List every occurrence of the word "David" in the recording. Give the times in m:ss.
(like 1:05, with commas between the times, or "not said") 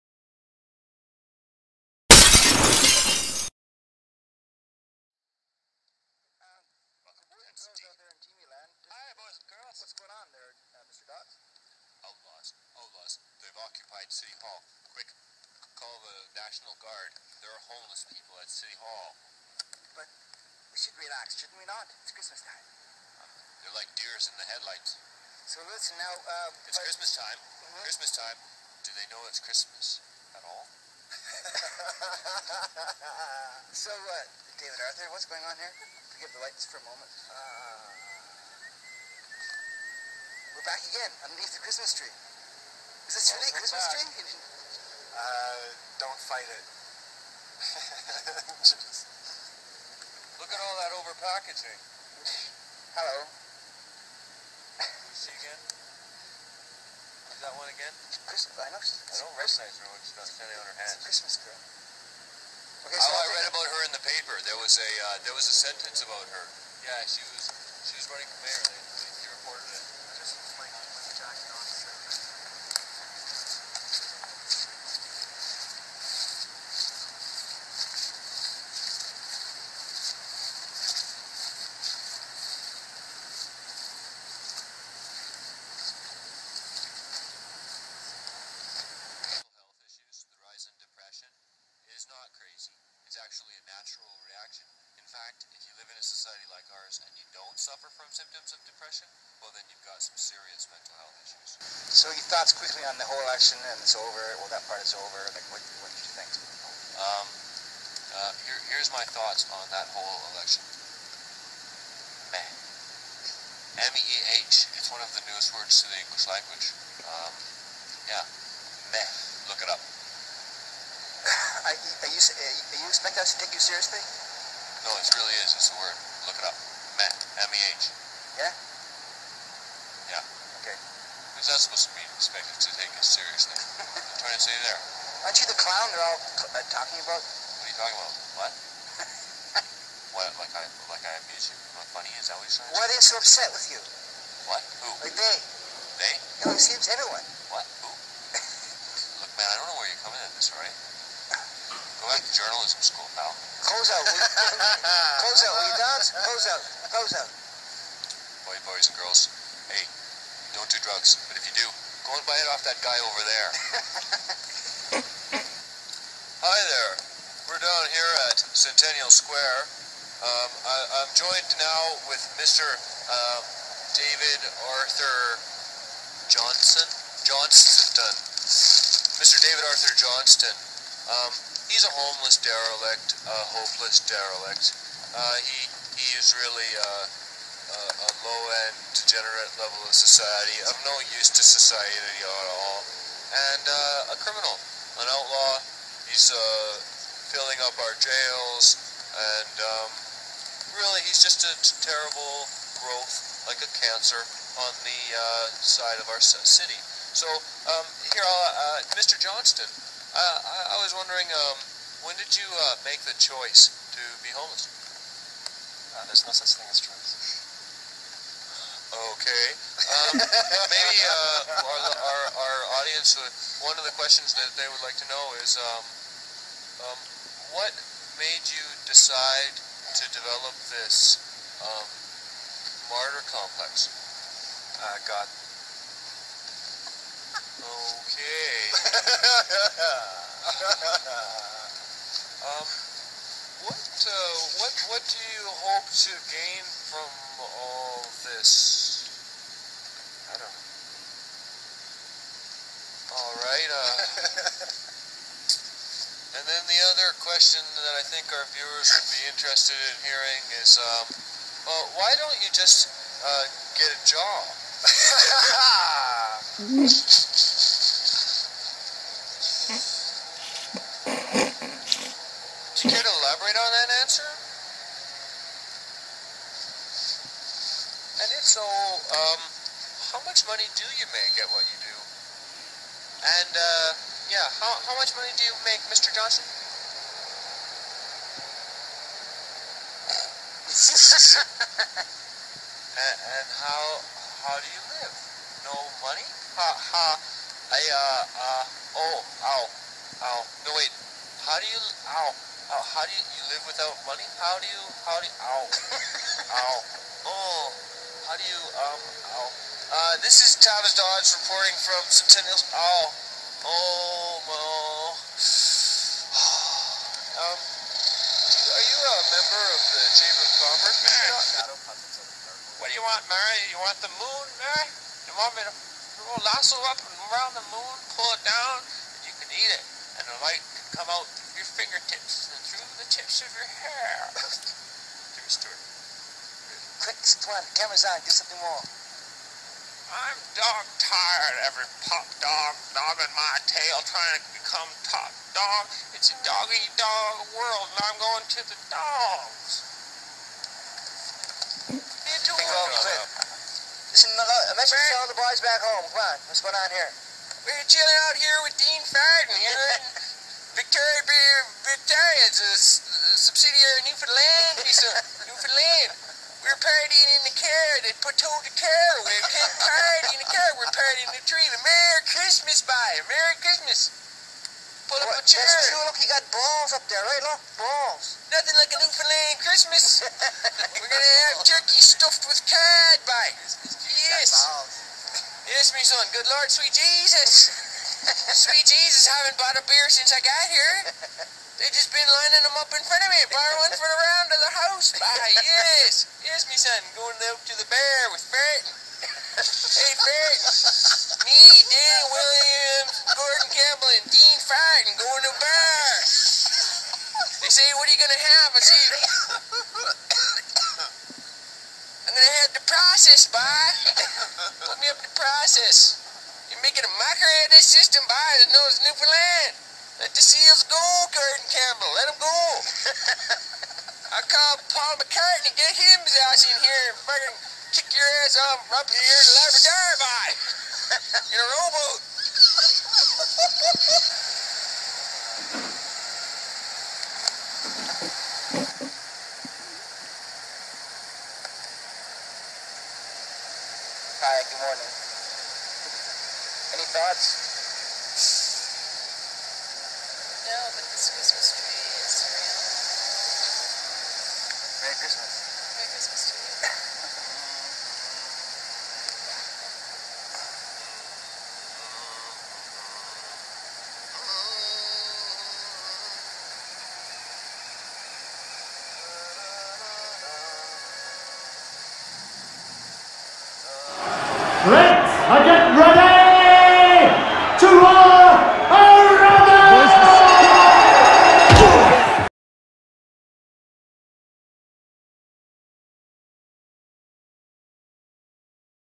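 0:34, 2:53, 2:59.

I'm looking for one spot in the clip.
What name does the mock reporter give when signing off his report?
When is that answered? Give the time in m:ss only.
5:10.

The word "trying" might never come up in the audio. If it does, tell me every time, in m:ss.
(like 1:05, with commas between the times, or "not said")
2:14, 5:44.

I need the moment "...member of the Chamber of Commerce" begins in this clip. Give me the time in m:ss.
5:19.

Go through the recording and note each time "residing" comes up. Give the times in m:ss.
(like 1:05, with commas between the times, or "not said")
not said.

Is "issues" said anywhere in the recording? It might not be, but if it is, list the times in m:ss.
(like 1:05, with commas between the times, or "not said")
1:41.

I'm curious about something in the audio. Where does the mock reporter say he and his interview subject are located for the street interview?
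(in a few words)
Centennial Square.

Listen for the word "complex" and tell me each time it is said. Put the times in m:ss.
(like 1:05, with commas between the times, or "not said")
3:53.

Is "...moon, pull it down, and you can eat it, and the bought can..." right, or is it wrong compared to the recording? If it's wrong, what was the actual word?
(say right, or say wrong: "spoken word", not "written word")
wrong: "light", not "bought".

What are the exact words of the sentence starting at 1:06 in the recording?
Yeah, she was she was running for mayor.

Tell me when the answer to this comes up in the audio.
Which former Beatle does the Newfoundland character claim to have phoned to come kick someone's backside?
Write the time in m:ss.
7:04.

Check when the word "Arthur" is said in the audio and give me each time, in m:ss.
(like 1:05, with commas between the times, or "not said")
0:34, 2:54, 2:59.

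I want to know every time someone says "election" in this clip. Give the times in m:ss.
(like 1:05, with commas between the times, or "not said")
1:43, 1:50.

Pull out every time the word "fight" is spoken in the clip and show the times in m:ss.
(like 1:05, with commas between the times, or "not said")
0:46.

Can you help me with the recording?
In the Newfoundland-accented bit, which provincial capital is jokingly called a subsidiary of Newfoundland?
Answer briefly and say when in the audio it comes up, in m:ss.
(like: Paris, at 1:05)
Victoria, at 6:00.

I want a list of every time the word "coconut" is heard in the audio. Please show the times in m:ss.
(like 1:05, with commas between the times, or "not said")
not said.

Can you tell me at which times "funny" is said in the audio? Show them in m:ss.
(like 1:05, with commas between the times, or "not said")
2:21.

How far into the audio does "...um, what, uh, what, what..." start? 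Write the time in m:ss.
4:02.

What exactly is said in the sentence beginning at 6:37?
Going out to the bear with Barton.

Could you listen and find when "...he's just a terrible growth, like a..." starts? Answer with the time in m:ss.
3:21.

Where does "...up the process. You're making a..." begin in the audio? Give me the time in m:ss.
6:55.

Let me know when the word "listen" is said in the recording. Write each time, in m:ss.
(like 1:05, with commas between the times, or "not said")
0:25, 5:54.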